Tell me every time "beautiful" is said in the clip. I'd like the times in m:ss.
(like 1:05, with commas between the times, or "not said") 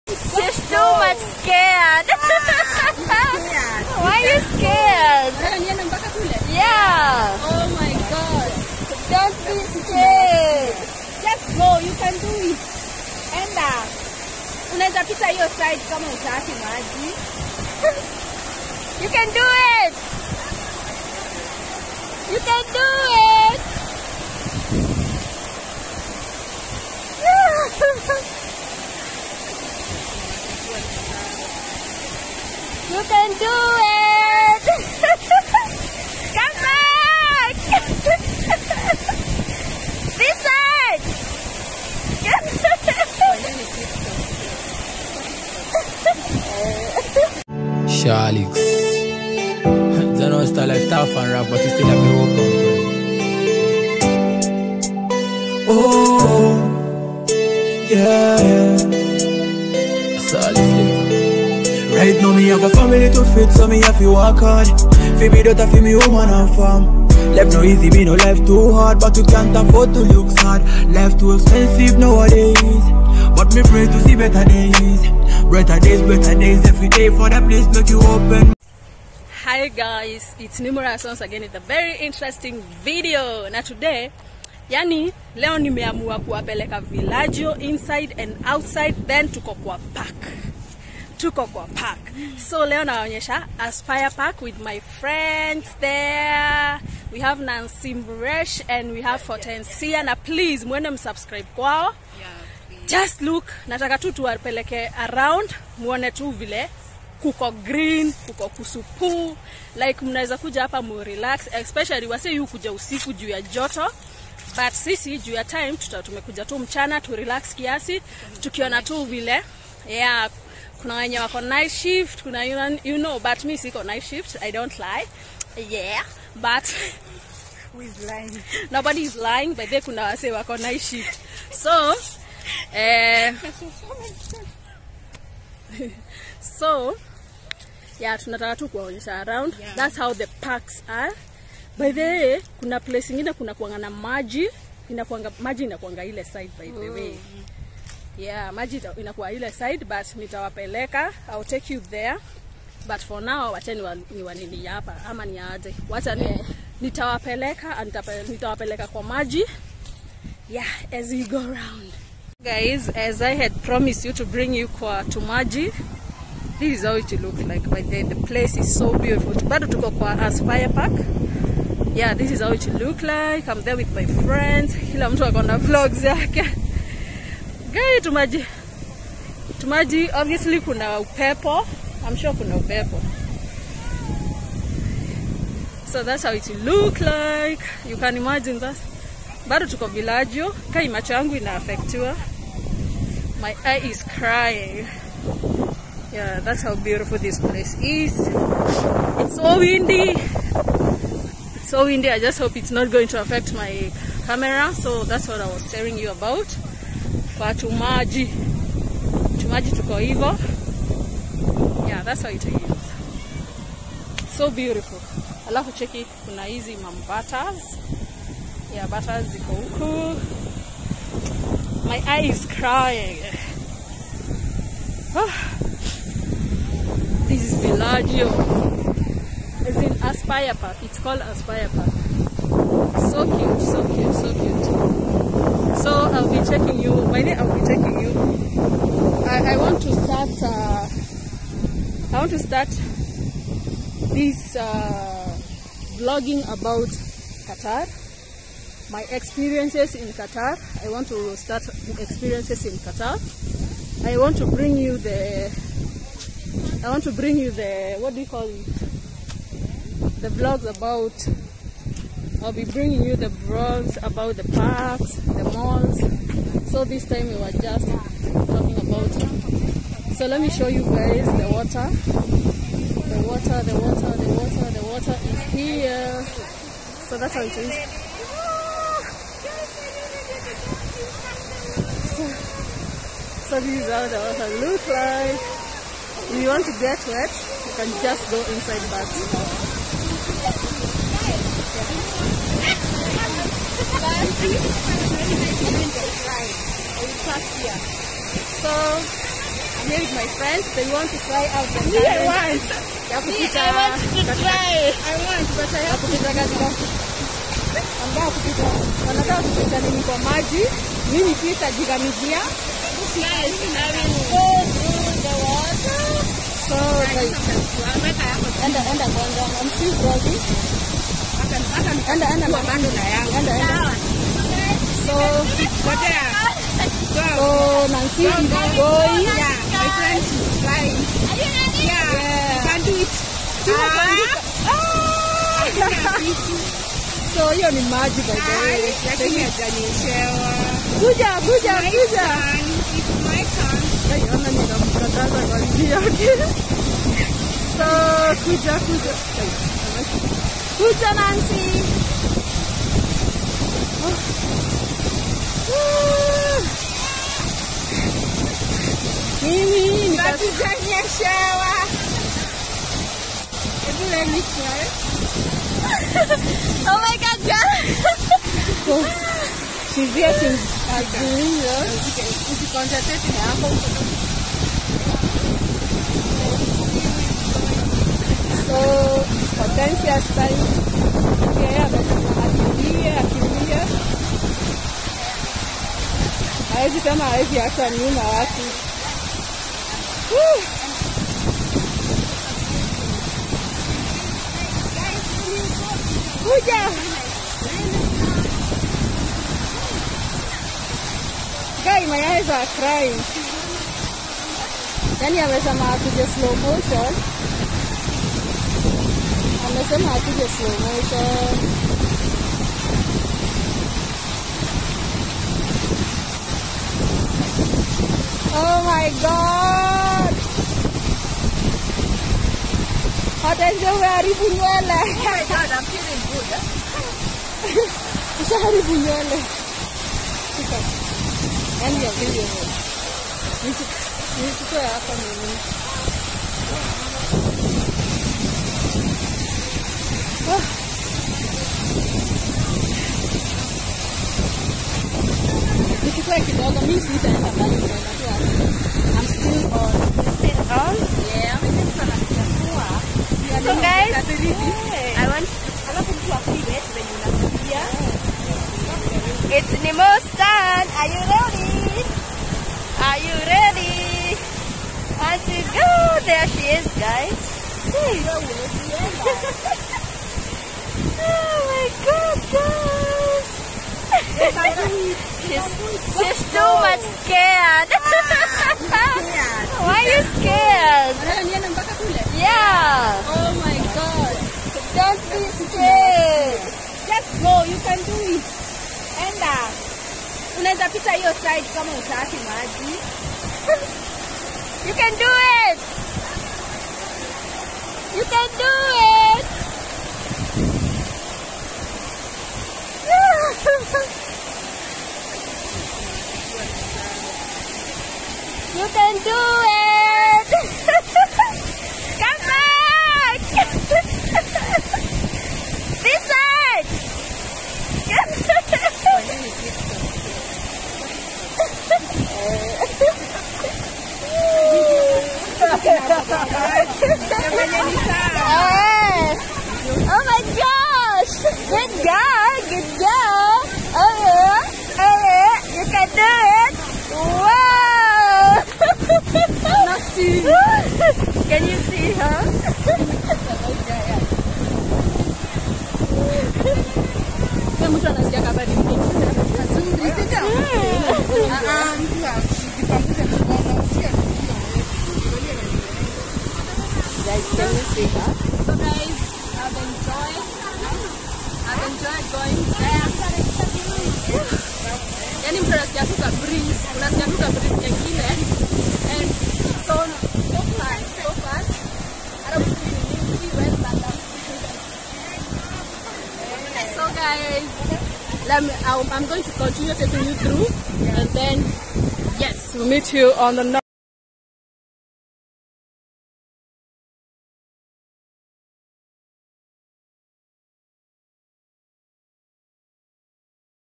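2:48, 3:16, 3:34.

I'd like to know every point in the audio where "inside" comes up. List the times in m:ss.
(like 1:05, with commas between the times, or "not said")
1:27, 4:48.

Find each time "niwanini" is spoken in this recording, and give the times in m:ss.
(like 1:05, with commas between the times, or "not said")
2:34.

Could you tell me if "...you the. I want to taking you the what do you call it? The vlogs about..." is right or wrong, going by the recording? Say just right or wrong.
wrong.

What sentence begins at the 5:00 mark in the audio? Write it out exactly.
They want to try out the Yeah, I want.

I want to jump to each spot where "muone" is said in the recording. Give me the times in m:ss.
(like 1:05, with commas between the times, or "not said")
1:45.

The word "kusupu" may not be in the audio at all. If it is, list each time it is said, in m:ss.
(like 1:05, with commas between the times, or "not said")
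1:48.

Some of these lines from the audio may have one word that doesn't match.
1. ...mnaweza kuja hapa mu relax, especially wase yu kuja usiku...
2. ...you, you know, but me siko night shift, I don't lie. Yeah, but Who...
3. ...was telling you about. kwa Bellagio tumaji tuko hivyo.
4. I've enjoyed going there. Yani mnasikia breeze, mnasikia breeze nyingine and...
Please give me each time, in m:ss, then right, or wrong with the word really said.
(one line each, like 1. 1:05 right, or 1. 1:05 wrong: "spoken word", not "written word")
1. 1:50 right
2. 2:02 right
3. 3:25 wrong: "Tumaji", not "Bellagio"
4. 9:21 right.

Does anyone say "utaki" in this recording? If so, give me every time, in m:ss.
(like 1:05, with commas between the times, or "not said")
0:16, 8:11.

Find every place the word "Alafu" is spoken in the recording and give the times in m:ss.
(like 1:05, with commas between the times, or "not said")
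3:35, 9:32.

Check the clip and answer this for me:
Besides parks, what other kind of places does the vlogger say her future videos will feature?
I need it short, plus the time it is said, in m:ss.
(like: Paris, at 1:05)
malls, at 4:25.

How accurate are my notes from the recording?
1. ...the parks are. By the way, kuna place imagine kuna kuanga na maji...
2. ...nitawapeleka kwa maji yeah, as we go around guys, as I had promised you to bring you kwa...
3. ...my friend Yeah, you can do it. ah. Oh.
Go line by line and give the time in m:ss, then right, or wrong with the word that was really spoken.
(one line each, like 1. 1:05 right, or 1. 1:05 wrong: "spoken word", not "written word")
1. 2:20 wrong: "ingine", not "imagine"
2. 2:38 right
3. 5:29 right.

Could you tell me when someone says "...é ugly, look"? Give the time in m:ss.
6:10.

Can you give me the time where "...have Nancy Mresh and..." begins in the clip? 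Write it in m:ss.
1:37.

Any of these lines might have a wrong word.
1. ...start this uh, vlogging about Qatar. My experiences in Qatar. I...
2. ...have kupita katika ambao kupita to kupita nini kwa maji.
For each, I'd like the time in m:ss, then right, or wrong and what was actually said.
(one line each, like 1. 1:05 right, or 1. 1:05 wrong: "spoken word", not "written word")
1. 4:02 right
2. 5:05 right.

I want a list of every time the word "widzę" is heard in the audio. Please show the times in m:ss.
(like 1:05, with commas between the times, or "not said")
6:00.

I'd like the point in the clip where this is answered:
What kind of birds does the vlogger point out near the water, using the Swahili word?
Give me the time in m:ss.
3:38.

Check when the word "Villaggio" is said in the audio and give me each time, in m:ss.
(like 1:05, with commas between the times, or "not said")
1:26, 3:09.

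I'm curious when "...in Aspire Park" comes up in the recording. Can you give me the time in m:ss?
3:49.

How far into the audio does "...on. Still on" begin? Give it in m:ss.
7:29.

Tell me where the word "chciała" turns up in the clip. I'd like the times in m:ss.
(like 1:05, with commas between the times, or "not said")
6:01.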